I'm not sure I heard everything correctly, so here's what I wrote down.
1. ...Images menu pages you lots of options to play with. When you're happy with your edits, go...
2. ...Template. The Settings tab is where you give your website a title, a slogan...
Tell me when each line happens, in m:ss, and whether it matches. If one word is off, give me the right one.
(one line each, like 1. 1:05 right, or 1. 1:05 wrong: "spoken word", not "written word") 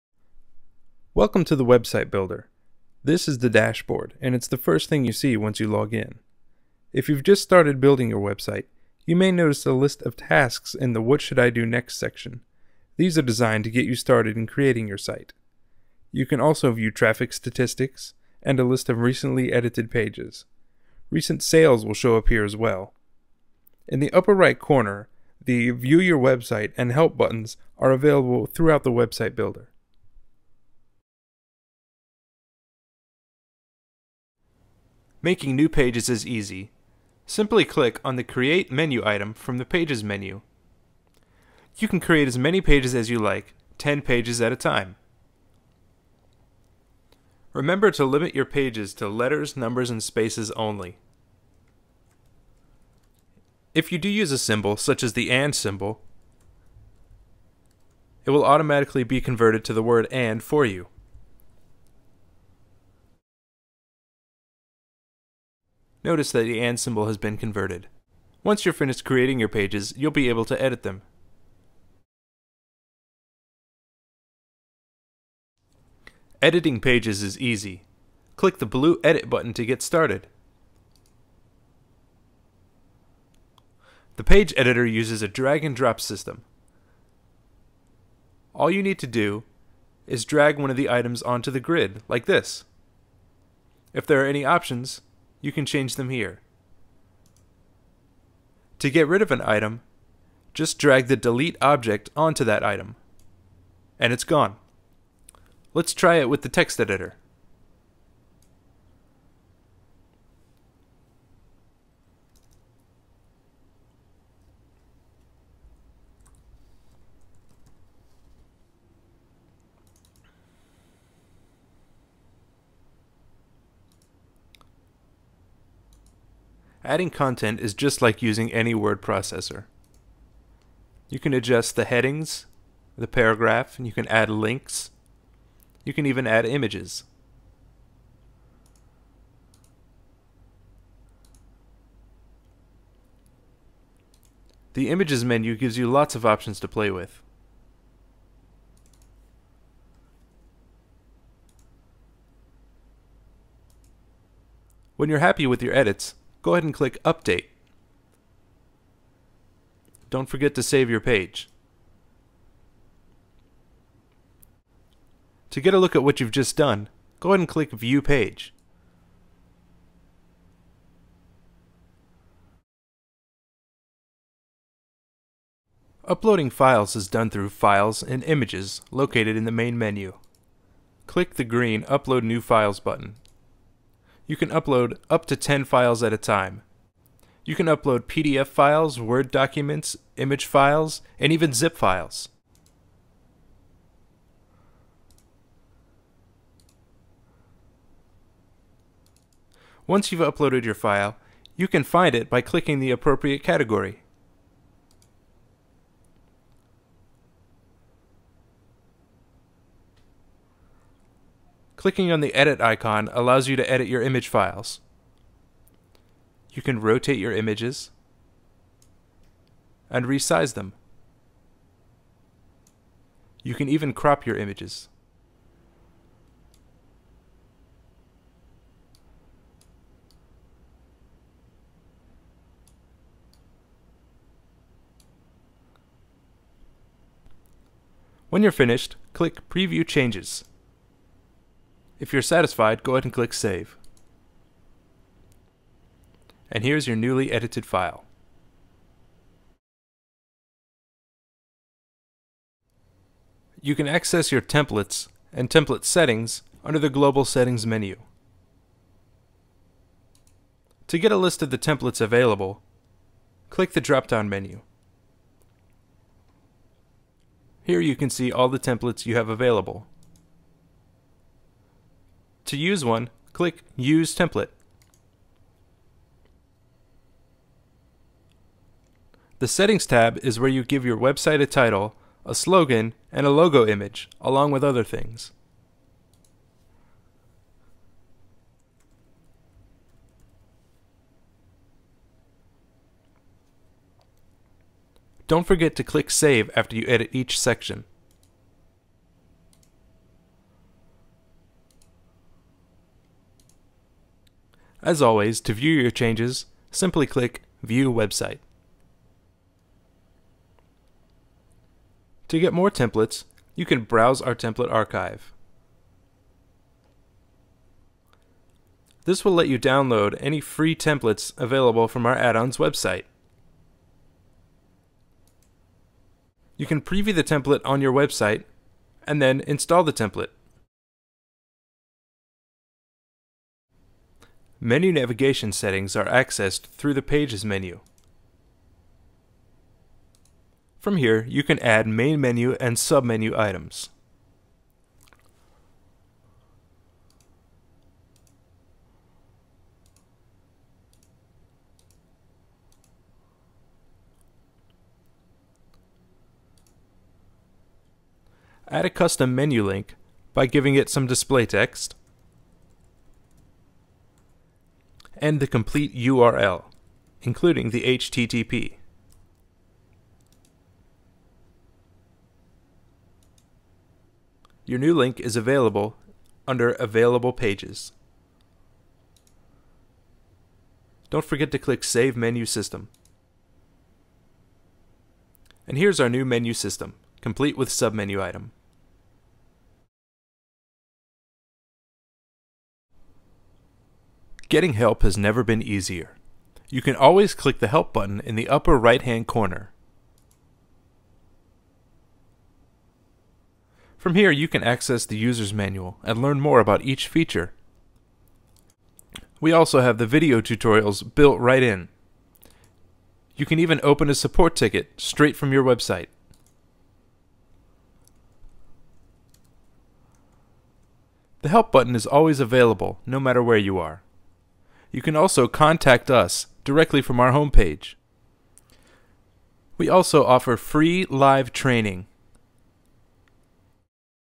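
1. 2:24 wrong: "gives", not "pages"
2. 4:34 right.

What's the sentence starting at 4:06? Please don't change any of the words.
And here's your newly edited file.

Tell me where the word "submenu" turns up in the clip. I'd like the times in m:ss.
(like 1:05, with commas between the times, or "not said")
5:42, 6:27.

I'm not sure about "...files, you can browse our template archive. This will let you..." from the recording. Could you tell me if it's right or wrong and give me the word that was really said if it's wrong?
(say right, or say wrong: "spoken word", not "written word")
wrong: "templates", not "files".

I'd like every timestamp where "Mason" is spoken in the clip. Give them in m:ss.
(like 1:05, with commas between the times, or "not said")
not said.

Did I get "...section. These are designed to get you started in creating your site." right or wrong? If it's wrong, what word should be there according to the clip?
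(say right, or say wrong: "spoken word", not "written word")
right.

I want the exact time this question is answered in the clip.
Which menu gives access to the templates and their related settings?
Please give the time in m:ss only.
4:16.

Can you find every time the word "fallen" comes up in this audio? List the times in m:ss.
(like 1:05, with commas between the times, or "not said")
not said.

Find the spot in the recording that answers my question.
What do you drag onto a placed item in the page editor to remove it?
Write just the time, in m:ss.
1:41.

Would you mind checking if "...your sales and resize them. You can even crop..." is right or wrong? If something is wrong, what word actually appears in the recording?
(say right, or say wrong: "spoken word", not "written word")
wrong: "images", not "sales".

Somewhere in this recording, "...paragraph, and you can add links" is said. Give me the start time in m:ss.
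2:13.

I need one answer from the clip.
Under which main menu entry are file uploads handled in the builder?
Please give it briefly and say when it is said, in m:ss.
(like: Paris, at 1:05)
Files and Images, at 2:57.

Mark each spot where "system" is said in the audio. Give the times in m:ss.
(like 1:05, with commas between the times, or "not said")
1:26, 6:22, 6:26.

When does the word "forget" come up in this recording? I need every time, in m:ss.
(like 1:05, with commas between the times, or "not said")
2:40, 4:55, 6:21.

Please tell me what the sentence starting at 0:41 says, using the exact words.
You can create as many pages as you like, 10 pages at a time.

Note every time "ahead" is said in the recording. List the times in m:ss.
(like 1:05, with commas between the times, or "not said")
2:36, 2:47, 4:02.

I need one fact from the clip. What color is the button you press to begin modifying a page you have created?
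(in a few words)
Blue.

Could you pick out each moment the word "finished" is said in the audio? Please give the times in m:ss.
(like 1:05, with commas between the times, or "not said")
1:08, 3:58.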